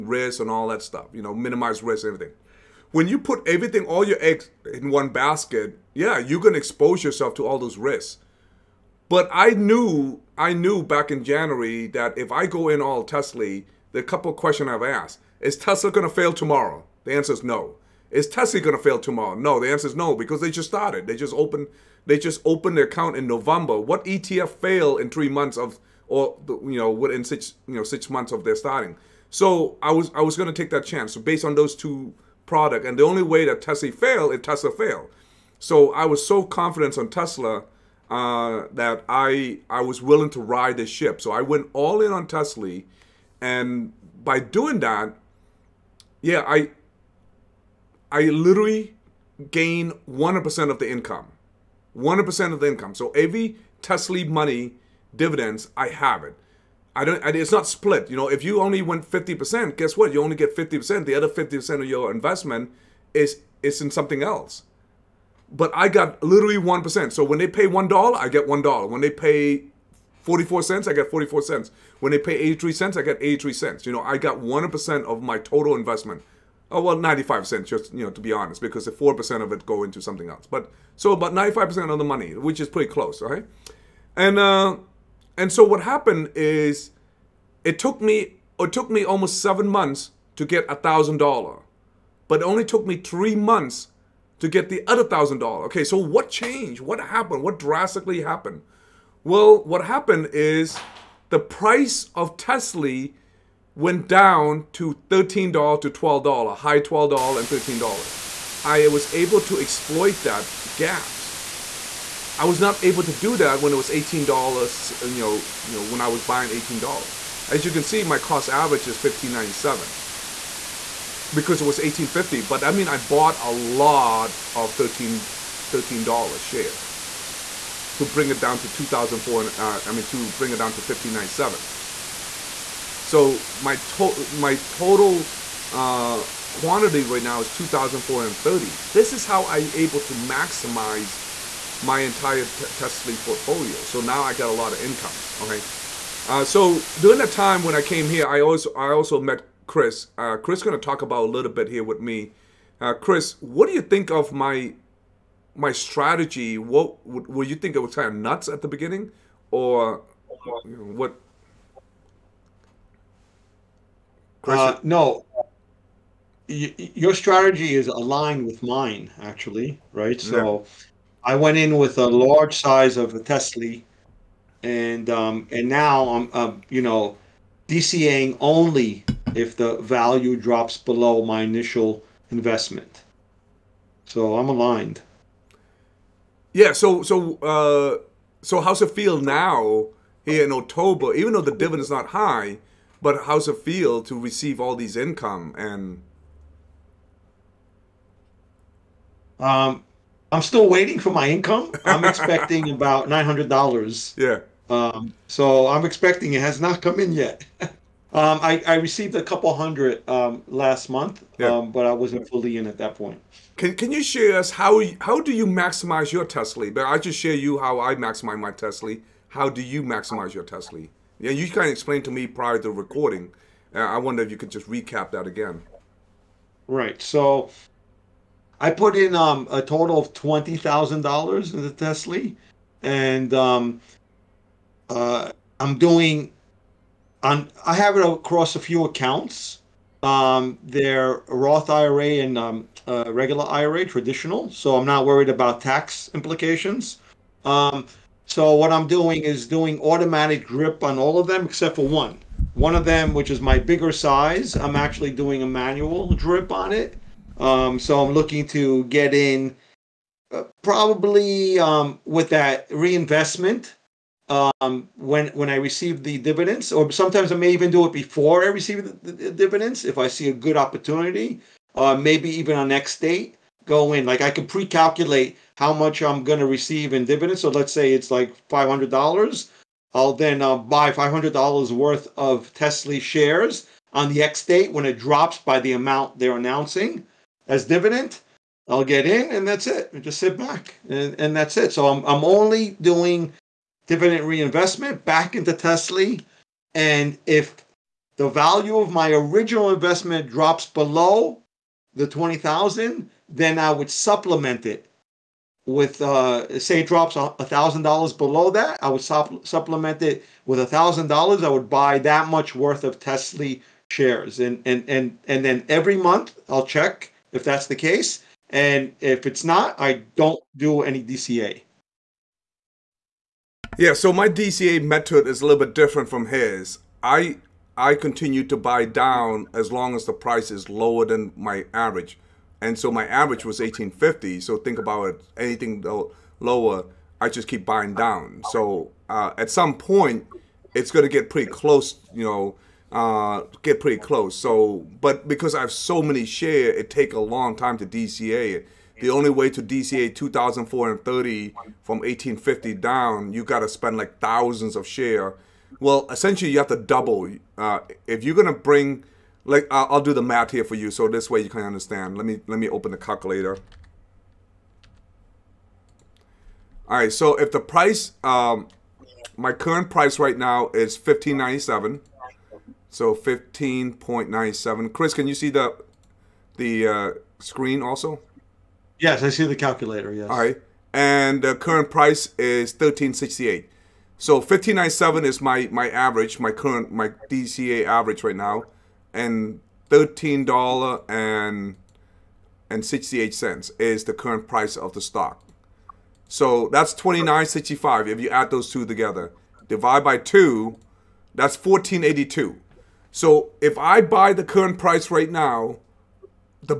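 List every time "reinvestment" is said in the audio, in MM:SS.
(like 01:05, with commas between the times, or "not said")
04:22, 04:54.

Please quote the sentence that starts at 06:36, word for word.
So that's 29.65 if you add those two together.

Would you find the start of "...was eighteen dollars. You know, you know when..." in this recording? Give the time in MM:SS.
01:53.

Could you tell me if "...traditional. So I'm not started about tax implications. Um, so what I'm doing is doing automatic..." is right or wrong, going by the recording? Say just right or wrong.
wrong.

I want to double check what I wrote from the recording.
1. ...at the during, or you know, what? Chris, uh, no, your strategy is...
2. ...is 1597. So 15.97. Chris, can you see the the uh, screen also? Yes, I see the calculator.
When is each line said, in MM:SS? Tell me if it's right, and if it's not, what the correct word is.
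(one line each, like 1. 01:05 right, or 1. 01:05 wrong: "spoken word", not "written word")
1. 02:38 wrong: "beginning", not "during"
2. 06:10 right.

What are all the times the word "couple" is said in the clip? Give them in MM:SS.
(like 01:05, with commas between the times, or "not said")
00:14, 03:29.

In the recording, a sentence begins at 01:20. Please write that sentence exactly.
But so about ninety five percent of the money, which is pretty close, right?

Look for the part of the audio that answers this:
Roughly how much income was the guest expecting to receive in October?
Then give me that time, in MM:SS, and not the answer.
03:23.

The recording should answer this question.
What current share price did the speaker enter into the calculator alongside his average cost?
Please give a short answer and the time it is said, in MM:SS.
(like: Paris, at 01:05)
$13.68, at 06:22.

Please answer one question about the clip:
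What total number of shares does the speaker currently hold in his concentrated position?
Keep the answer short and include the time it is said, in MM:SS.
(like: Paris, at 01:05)
2,430, at 02:17.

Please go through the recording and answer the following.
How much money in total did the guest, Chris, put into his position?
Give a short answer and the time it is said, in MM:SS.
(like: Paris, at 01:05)
$20,000, at 03:50.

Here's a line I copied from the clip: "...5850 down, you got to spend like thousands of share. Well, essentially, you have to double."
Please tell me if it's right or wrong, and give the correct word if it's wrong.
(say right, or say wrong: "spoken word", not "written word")
wrong: "1850", not "5850".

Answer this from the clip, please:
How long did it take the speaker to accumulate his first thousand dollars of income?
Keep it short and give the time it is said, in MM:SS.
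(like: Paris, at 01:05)
almost 7 months, at 01:29.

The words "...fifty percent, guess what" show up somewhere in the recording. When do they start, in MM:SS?
00:59.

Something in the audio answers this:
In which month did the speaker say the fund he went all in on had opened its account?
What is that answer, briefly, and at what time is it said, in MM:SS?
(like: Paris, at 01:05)
November, at 00:23.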